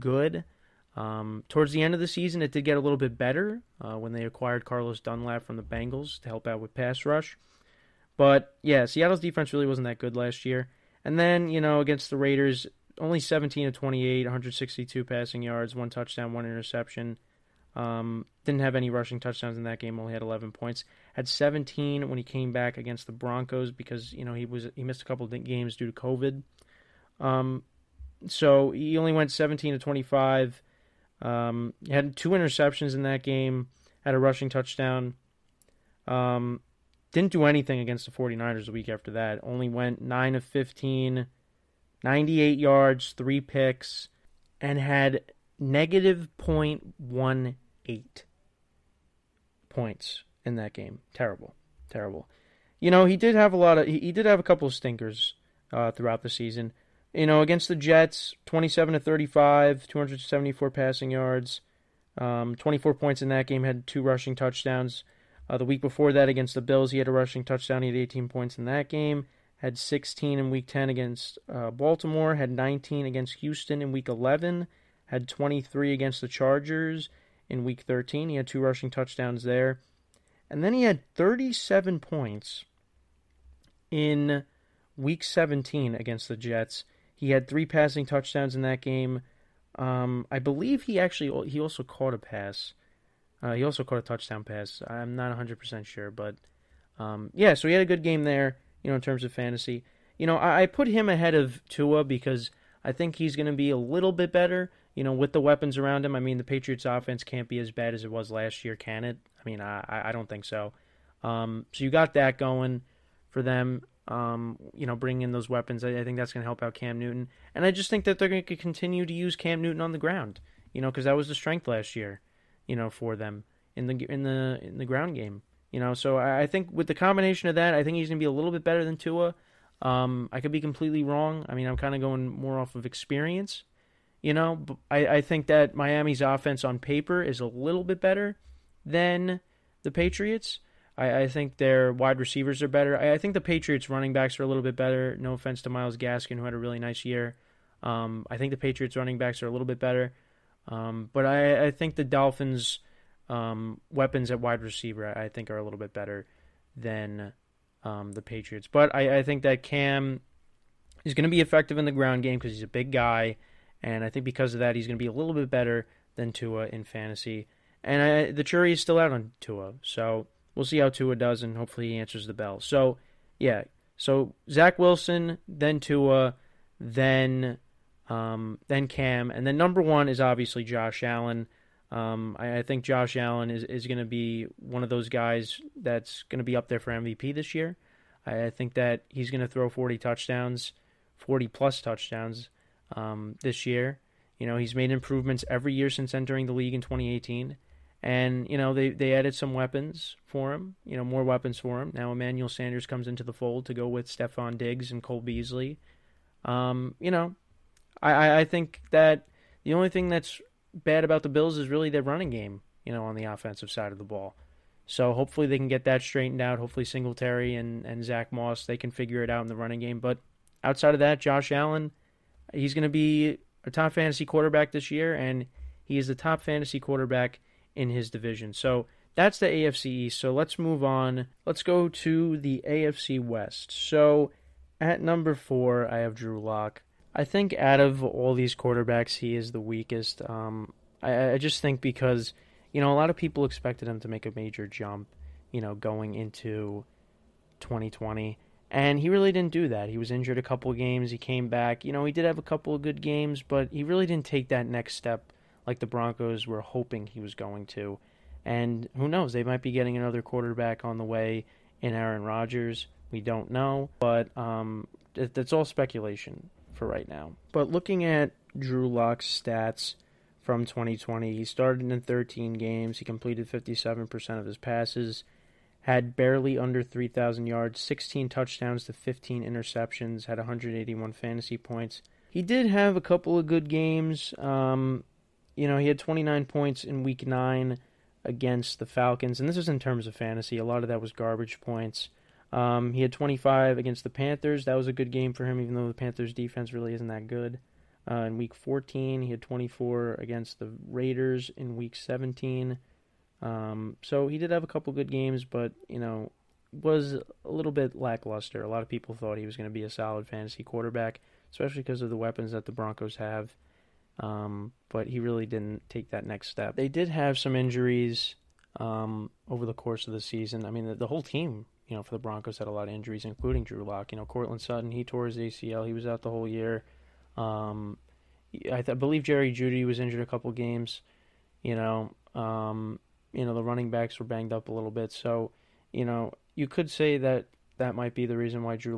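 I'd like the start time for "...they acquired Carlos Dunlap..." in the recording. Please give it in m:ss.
0:04.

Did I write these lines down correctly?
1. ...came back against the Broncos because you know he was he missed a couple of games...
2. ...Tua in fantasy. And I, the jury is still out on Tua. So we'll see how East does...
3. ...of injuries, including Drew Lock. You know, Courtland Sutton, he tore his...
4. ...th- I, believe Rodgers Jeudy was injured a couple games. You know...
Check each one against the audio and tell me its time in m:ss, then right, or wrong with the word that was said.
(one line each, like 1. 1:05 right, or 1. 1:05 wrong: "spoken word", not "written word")
1. 0:22 right
2. 2:46 wrong: "Tua", not "East"
3. 5:22 right
4. 5:28 wrong: "Jerry", not "Rodgers".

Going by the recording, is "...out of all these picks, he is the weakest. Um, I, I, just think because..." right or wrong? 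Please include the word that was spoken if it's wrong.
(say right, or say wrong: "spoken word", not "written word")
wrong: "quarterbacks", not "picks".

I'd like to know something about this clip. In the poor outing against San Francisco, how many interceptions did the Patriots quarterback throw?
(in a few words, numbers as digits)
3.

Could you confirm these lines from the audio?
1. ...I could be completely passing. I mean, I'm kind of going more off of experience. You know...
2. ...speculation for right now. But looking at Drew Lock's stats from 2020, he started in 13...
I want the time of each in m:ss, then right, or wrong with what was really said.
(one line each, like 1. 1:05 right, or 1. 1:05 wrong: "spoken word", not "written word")
1. 2:10 wrong: "wrong", not "passing"
2. 4:25 right.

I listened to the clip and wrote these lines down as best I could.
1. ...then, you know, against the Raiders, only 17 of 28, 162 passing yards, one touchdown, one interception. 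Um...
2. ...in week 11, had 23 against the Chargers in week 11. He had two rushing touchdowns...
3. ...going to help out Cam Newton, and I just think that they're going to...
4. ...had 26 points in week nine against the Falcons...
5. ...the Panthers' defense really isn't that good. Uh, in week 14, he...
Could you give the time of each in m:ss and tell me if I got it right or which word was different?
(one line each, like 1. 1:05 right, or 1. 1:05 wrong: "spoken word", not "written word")
1. 0:11 right
2. 1:13 wrong: "13", not "11"
3. 1:56 right
4. 4:45 wrong: "29", not "26"
5. 4:55 right.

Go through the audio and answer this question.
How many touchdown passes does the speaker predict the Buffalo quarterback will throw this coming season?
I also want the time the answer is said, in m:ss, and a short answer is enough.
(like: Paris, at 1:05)
40, at 3:09.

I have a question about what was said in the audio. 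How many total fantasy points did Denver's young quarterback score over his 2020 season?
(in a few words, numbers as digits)
181.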